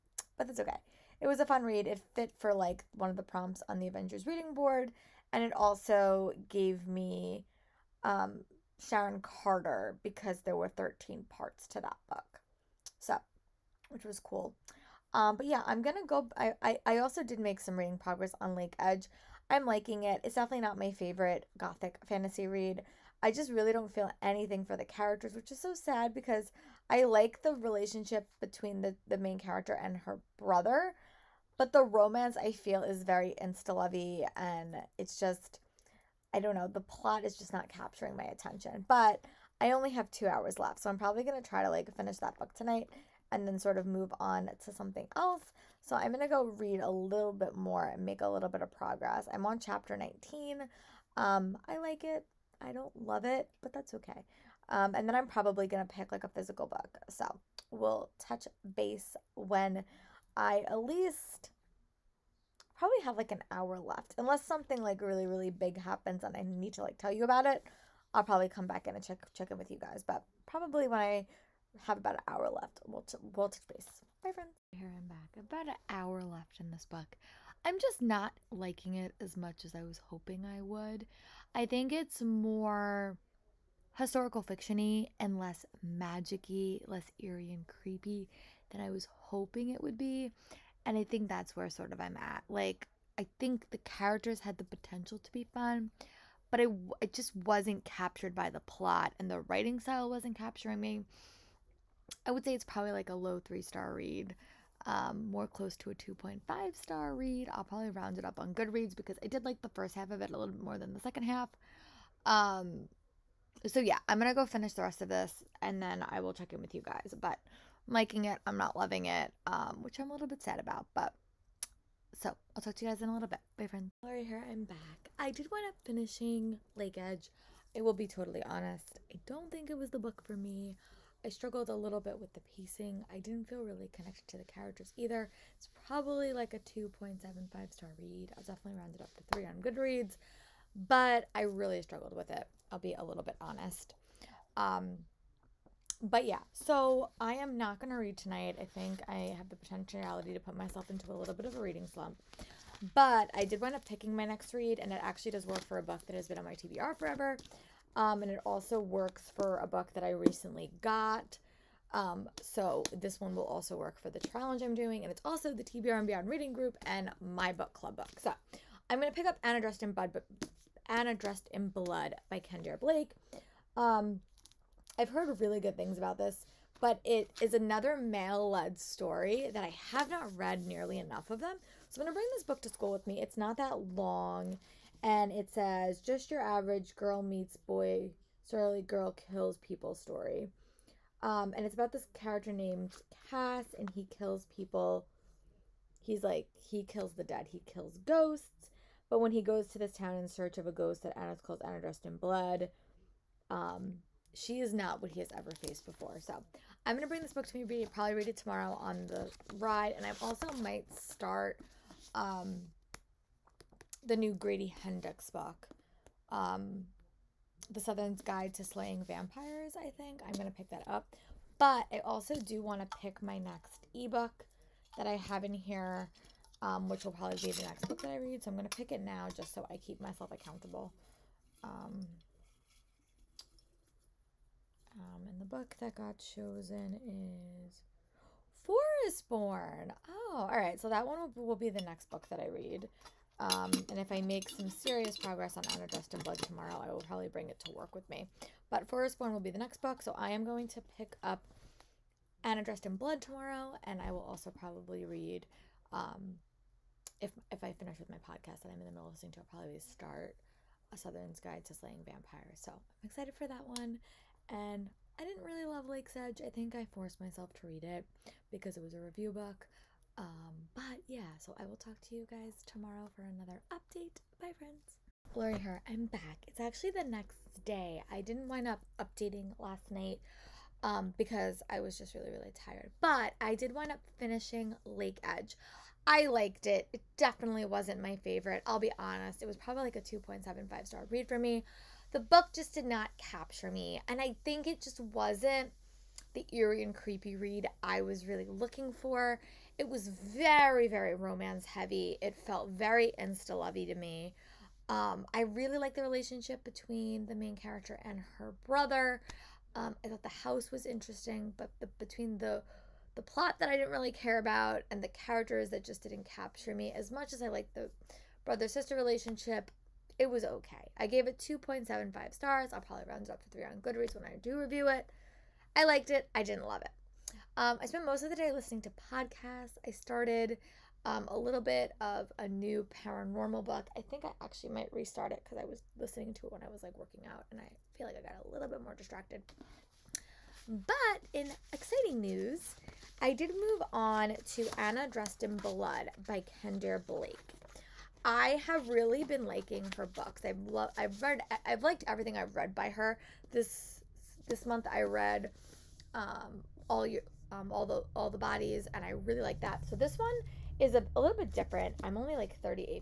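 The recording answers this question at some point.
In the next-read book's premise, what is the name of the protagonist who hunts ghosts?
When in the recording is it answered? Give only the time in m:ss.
3:13.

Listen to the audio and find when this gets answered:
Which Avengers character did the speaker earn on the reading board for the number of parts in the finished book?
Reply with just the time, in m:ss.
0:08.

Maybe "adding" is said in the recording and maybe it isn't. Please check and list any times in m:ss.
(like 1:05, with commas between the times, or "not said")
not said.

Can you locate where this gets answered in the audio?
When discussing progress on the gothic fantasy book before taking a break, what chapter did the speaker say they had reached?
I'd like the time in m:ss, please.
0:49.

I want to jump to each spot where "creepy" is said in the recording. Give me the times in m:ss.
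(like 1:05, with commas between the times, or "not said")
1:27, 4:56.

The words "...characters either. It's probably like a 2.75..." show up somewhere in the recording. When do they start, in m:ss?
2:14.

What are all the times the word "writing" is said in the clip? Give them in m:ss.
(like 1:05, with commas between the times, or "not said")
1:39.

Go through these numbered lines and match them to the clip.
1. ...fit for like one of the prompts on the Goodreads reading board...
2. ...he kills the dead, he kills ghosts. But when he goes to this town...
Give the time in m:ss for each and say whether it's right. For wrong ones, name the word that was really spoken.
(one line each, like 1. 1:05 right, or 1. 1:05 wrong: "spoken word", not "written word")
1. 0:02 wrong: "Avengers", not "Goodreads"
2. 3:16 right.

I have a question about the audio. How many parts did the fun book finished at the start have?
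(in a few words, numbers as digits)
13.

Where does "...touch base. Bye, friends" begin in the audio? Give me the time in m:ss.
1:13.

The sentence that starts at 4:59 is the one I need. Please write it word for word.
It was very, very romance heavy.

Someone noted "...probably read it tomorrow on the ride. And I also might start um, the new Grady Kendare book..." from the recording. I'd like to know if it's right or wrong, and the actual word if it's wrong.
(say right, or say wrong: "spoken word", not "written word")
wrong: "Hendrix", not "Kendare".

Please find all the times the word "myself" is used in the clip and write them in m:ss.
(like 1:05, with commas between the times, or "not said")
2:30, 3:49, 4:27.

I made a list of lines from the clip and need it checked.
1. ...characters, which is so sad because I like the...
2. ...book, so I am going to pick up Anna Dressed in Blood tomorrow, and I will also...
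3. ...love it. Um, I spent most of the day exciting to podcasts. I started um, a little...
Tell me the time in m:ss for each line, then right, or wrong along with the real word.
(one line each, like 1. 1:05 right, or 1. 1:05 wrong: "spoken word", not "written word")
1. 0:24 right
2. 4:09 right
3. 5:26 wrong: "listening", not "exciting".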